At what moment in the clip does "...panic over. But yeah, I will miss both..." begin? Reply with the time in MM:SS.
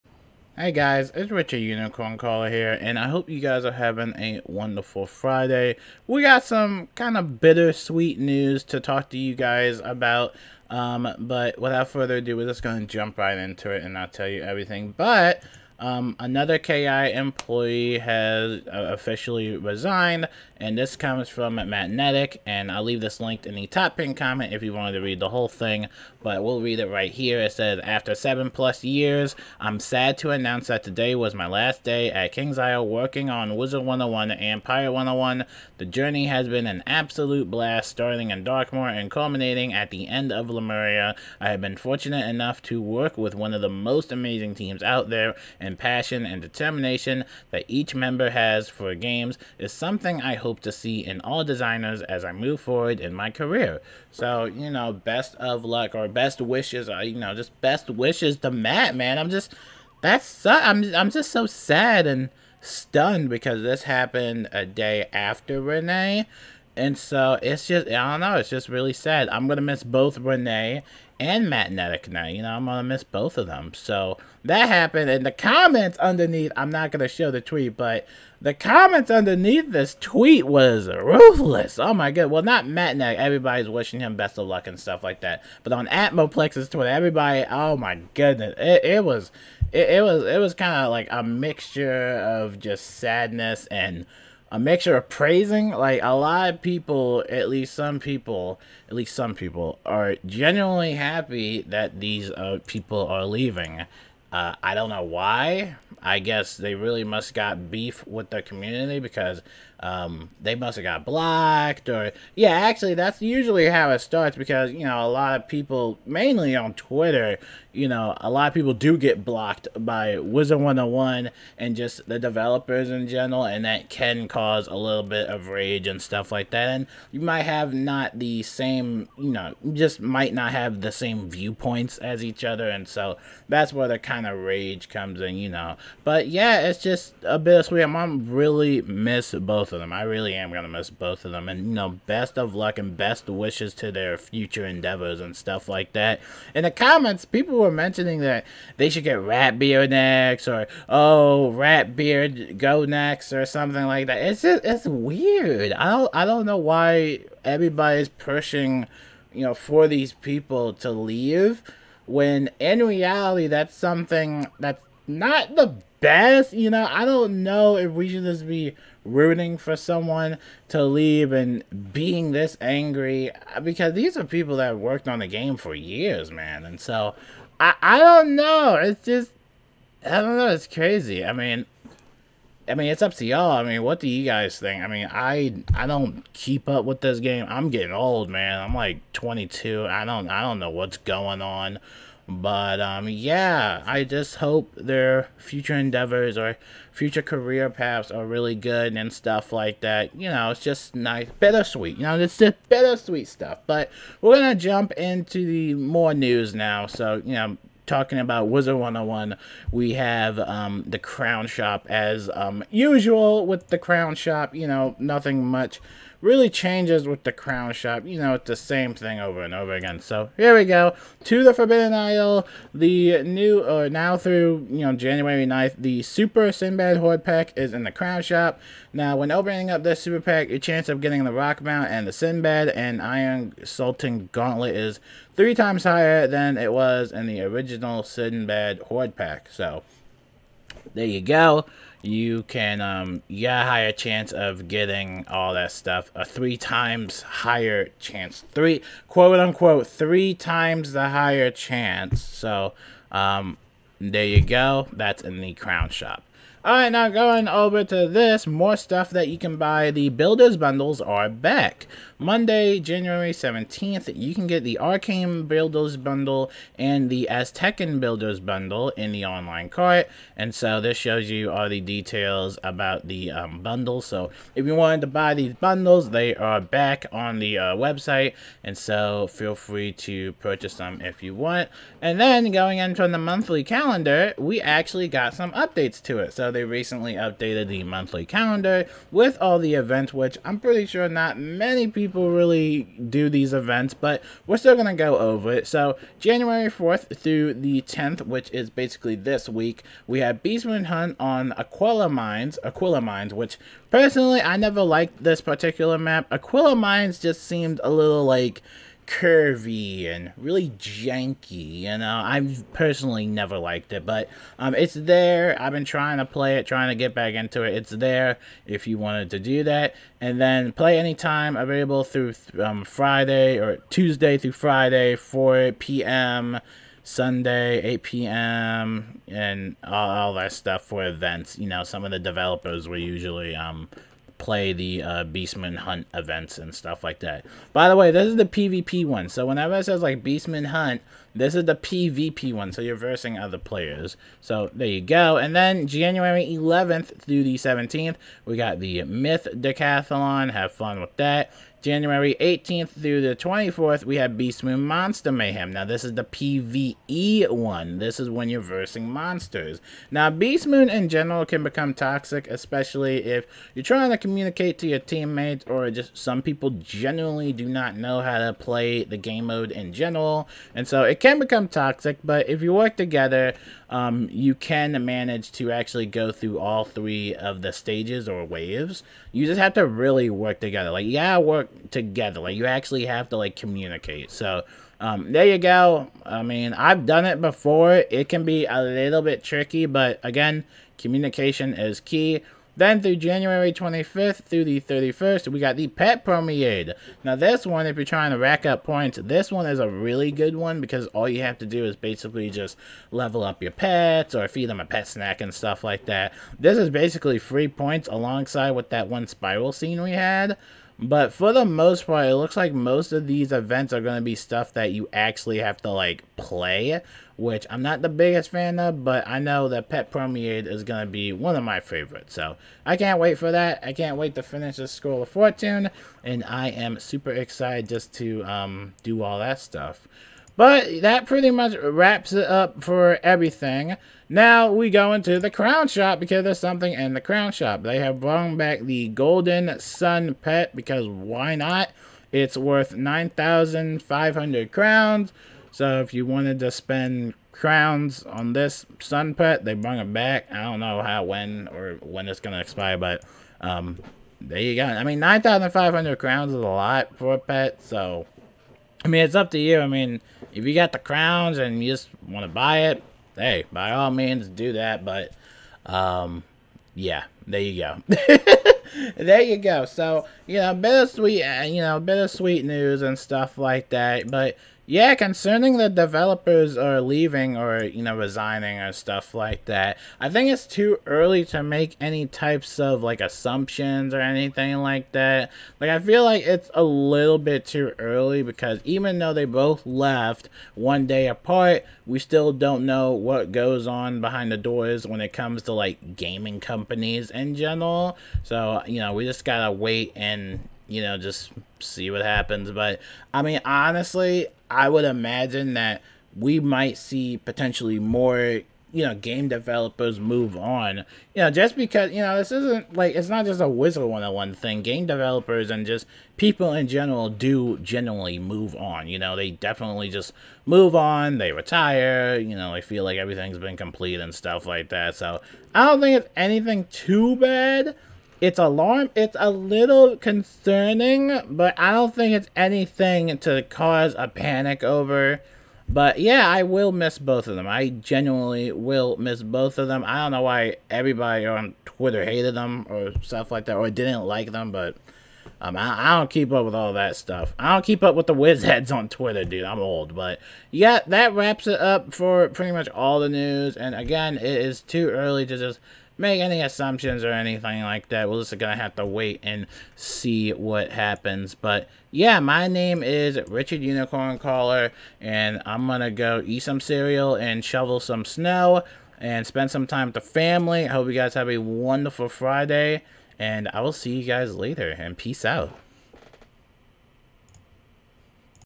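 08:54.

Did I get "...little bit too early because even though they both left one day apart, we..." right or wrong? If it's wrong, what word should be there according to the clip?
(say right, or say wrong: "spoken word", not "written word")
right.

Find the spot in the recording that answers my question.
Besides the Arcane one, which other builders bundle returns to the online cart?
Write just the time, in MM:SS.
04:27.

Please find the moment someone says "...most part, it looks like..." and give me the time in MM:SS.
06:51.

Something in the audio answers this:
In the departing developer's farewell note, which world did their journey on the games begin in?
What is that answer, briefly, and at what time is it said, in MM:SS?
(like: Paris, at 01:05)
Darkmoor, at 00:38.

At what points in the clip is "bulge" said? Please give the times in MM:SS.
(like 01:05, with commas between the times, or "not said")
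not said.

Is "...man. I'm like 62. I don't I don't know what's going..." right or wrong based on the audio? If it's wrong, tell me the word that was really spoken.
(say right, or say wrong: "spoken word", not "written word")
wrong: "22", not "62".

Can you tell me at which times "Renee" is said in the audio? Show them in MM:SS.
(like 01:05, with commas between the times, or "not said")
01:05, 01:10.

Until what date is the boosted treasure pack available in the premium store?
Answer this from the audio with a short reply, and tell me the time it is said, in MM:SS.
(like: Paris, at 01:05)
January 9th, at 03:44.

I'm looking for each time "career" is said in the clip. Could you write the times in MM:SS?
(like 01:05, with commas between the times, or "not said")
00:53, 03:17.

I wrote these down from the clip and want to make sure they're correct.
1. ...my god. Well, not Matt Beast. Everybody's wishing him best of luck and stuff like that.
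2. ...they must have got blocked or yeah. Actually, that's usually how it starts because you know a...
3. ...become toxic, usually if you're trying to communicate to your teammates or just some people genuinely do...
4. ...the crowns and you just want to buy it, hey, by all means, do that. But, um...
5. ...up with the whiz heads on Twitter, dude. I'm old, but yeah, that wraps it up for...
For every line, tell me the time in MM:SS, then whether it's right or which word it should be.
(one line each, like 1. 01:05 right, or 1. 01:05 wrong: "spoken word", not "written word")
1. 01:21 wrong: "Nettick", not "Beast"
2. 01:50 right
3. 06:01 wrong: "especially", not "usually"
4. 07:40 right
5. 09:08 right.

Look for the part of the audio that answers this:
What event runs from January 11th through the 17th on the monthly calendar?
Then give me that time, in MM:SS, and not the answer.
05:49.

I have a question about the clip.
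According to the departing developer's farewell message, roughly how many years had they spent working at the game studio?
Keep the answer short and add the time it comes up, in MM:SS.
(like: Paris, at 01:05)
7 plus years, at 00:28.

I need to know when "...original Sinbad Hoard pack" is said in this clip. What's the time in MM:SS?
03:57.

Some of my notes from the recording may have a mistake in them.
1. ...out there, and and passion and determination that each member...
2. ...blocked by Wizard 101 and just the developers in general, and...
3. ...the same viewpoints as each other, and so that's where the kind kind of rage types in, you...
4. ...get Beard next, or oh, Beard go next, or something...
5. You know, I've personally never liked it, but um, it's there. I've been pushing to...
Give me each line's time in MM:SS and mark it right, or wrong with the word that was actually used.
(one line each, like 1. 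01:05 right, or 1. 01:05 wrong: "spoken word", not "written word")
1. 00:44 right
2. 01:59 right
3. 02:10 wrong: "comes", not "types"
4. 02:29 right
5. 05:11 wrong: "trying", not "pushing".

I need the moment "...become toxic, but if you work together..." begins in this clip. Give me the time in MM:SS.
06:11.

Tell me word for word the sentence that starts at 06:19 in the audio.
You just have to really work together.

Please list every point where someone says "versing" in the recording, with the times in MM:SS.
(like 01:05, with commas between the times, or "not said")
05:42, 05:58.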